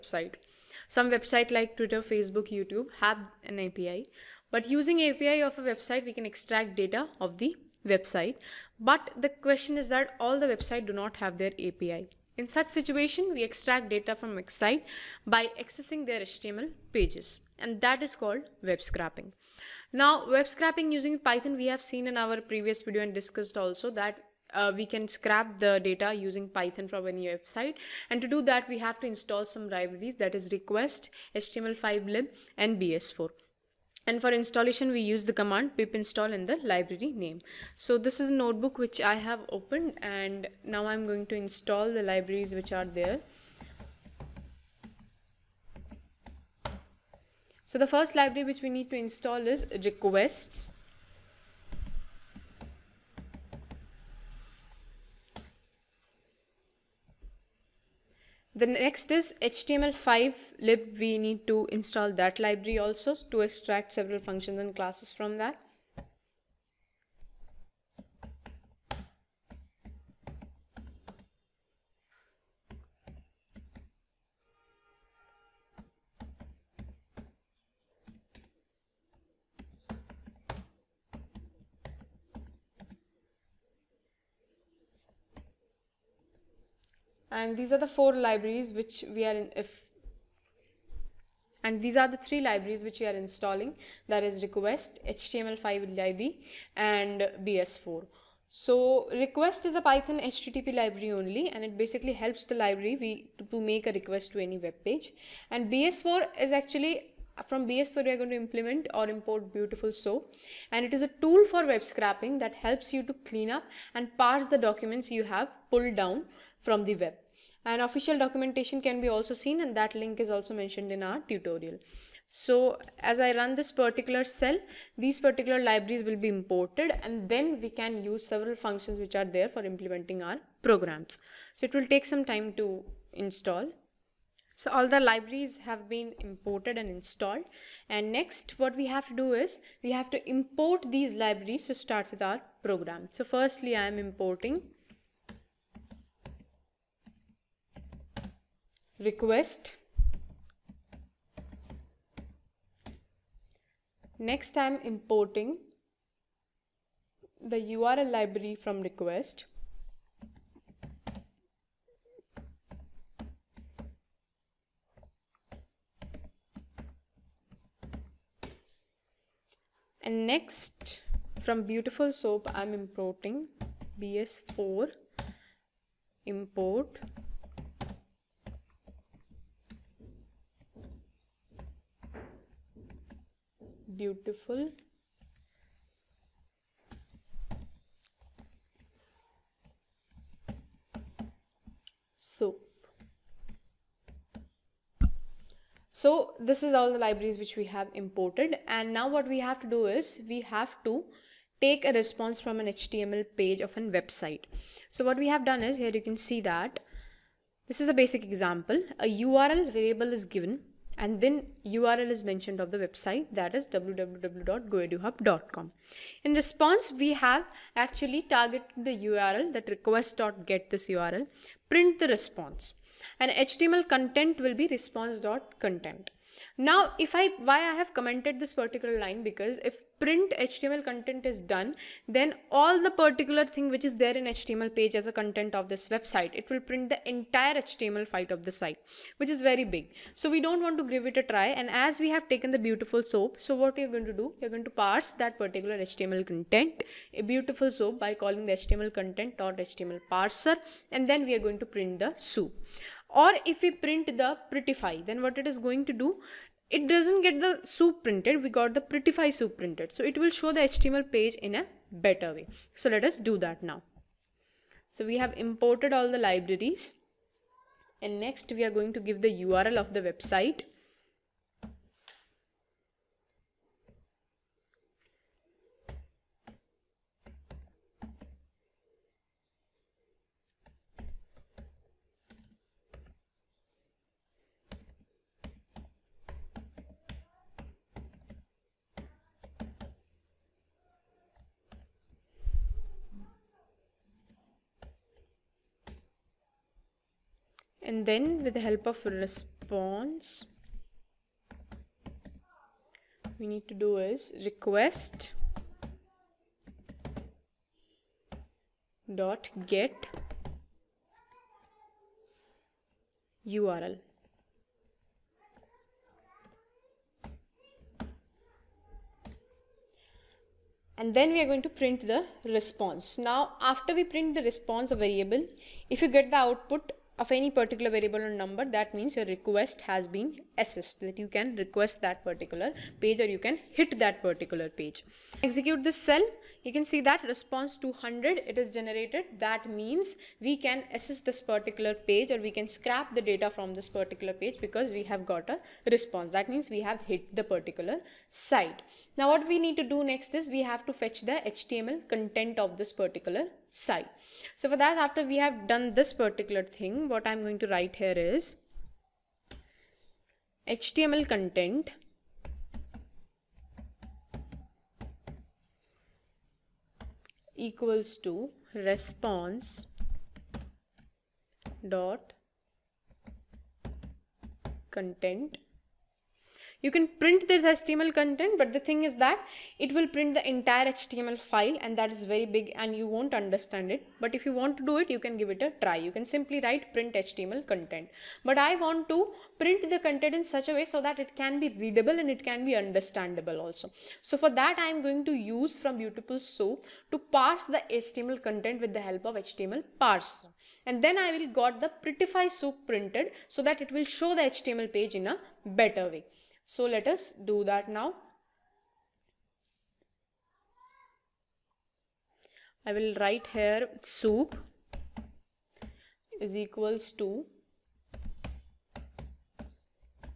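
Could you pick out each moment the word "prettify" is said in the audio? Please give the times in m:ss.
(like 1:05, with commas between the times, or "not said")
4:14, 4:18, 6:42.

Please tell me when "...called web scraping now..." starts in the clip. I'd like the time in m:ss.
0:18.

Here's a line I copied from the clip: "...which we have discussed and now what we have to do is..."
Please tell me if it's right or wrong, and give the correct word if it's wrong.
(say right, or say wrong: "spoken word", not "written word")
wrong: "imported", not "discussed".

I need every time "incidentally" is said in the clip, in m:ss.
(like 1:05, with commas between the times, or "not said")
not said.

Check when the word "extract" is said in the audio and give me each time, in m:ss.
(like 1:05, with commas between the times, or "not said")
0:06, 0:13, 1:03.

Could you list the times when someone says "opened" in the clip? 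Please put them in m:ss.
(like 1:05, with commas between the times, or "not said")
0:39.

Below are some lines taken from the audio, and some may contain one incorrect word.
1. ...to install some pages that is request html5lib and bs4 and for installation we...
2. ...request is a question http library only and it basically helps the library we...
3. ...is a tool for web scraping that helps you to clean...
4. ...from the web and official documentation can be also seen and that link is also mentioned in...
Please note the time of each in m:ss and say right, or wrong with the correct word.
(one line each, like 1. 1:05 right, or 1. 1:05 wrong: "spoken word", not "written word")
1. 0:28 wrong: "libraries", not "pages"
2. 1:39 wrong: "python", not "question"
3. 1:50 right
4. 1:56 right.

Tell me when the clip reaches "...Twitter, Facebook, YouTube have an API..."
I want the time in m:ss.
0:01.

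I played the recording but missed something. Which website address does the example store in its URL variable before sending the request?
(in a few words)
www.goeduhub.com.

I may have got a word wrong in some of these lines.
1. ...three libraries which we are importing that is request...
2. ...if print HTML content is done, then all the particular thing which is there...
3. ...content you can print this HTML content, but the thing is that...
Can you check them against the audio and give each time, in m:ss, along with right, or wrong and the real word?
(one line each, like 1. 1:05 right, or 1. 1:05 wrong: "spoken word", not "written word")
1. 1:32 wrong: "installing", not "importing"
2. 3:49 right
3. 6:14 right.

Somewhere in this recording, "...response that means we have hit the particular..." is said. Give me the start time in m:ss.
5:45.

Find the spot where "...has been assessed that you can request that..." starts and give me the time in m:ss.
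5:29.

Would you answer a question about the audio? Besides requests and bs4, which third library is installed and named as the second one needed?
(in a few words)
html5lib.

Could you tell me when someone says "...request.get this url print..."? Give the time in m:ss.
3:39.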